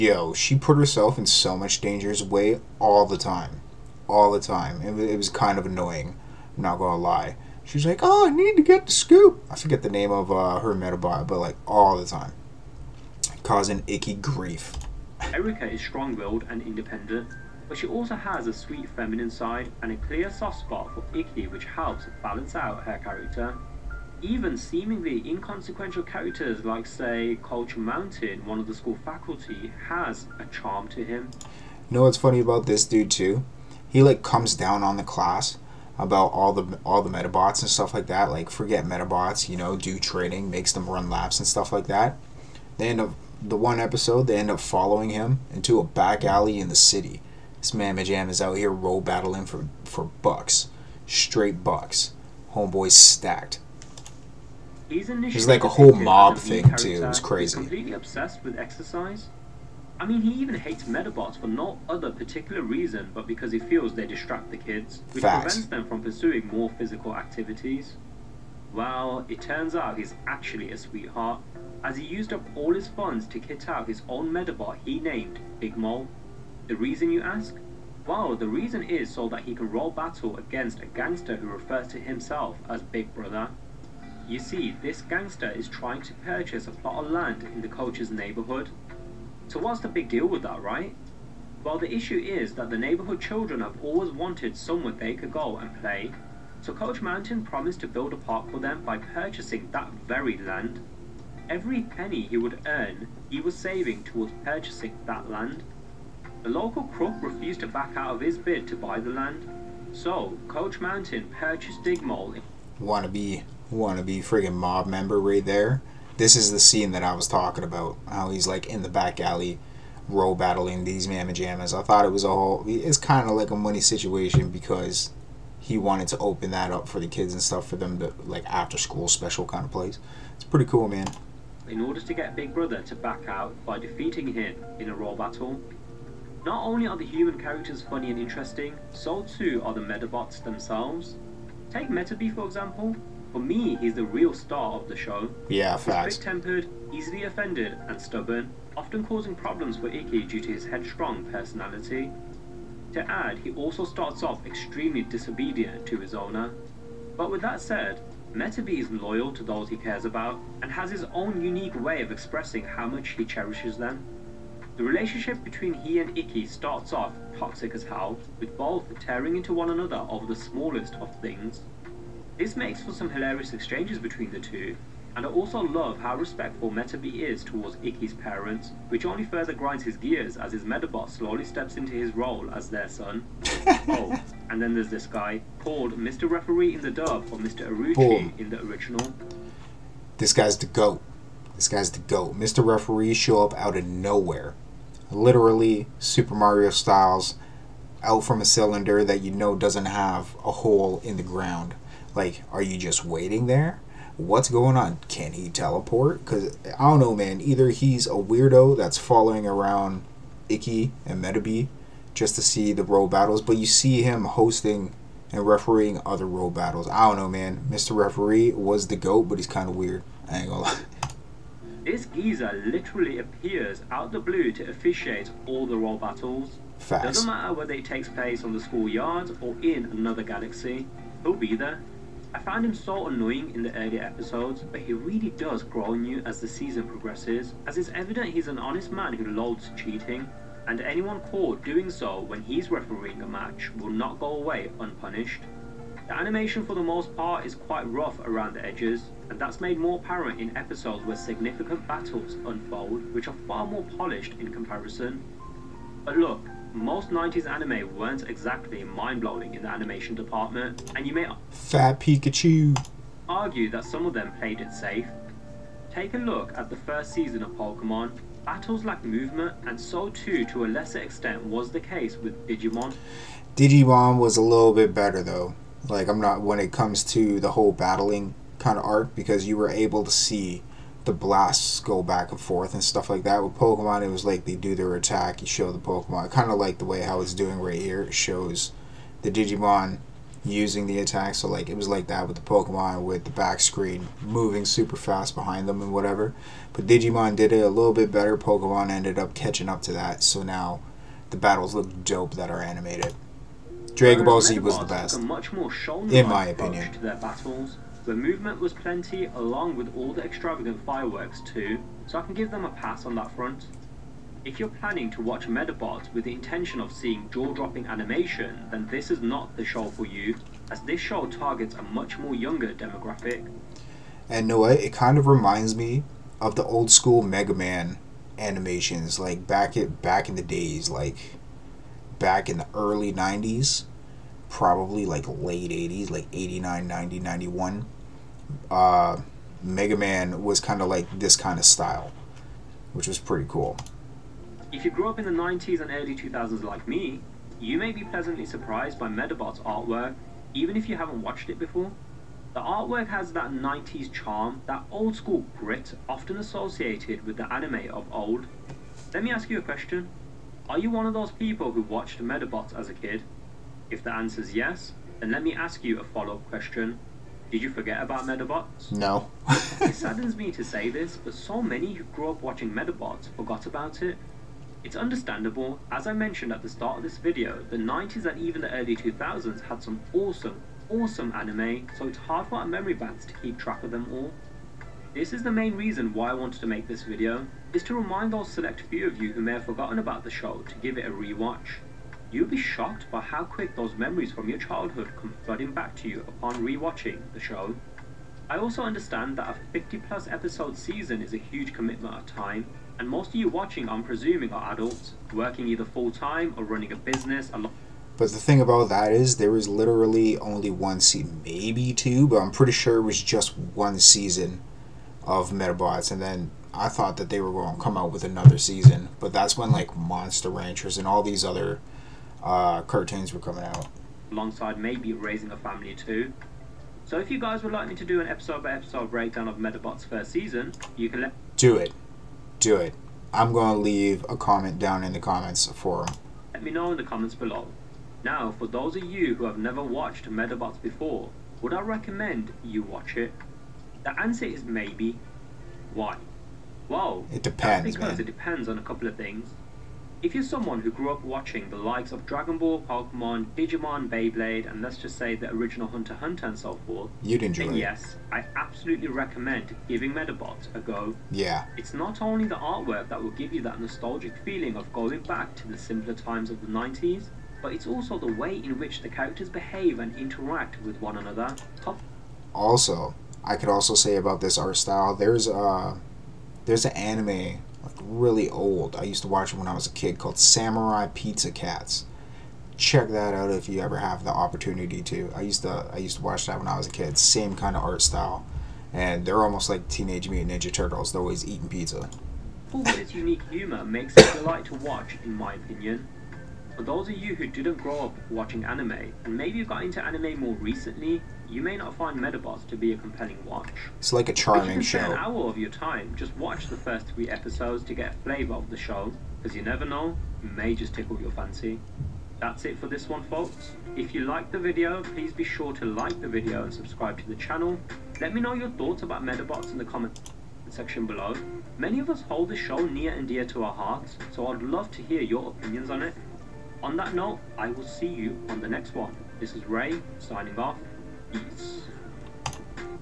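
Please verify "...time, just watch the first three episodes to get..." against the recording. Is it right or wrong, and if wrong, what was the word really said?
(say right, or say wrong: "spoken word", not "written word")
right.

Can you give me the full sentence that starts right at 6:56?
And then I thought that they were going to come out with another season.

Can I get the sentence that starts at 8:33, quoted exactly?
If you liked the video, please be sure to like the video and subscribe to the channel.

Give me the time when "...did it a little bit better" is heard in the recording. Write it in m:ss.
4:57.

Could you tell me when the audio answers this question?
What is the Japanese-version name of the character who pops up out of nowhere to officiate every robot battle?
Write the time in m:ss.
3:07.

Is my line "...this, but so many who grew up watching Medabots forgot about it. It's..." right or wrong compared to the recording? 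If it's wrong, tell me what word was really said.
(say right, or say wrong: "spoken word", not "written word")
right.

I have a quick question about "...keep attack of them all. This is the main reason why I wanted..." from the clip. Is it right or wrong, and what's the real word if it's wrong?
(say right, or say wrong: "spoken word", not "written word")
wrong: "track", not "attack".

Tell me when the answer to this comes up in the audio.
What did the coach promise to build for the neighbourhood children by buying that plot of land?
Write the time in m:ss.
1:38.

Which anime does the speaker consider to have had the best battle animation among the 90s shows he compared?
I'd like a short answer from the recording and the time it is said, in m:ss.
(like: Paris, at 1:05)
Dragon Ball Z, at 5:03.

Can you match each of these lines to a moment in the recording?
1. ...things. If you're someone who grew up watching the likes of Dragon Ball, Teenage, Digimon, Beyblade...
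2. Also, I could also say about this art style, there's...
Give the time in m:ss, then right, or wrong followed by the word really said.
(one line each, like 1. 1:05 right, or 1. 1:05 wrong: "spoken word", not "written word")
1. 7:29 wrong: "Pokemon", not "Teenage"
2. 7:52 right.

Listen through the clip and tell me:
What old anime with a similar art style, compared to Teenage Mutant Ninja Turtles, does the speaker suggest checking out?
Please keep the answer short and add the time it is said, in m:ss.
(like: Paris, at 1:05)
Samurai Pizza Cats, at 8:00.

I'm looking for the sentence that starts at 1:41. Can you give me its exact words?
Every penny he would earn, he was saving towards purchasing that land.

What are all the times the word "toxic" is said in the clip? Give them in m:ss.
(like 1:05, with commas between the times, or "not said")
2:47.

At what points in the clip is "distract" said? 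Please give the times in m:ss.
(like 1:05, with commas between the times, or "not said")
1:04.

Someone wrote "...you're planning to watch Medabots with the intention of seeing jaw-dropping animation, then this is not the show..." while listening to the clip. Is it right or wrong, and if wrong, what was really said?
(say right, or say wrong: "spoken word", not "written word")
right.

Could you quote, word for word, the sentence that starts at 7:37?
yes, I absolutely recommend giving Medabots a go.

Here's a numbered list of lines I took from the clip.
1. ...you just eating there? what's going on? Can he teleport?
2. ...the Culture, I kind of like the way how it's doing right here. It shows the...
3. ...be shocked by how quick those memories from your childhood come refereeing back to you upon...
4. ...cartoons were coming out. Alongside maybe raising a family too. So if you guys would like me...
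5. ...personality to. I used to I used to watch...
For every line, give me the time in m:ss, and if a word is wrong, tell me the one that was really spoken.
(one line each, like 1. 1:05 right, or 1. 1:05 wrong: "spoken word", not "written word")
1. 3:22 wrong: "waiting", not "eating"
2. 4:45 wrong: "Pokemon", not "Culture"
3. 6:32 wrong: "flooding", not "refereeing"
4. 7:02 right
5. 8:04 wrong: "opportunity", not "personality".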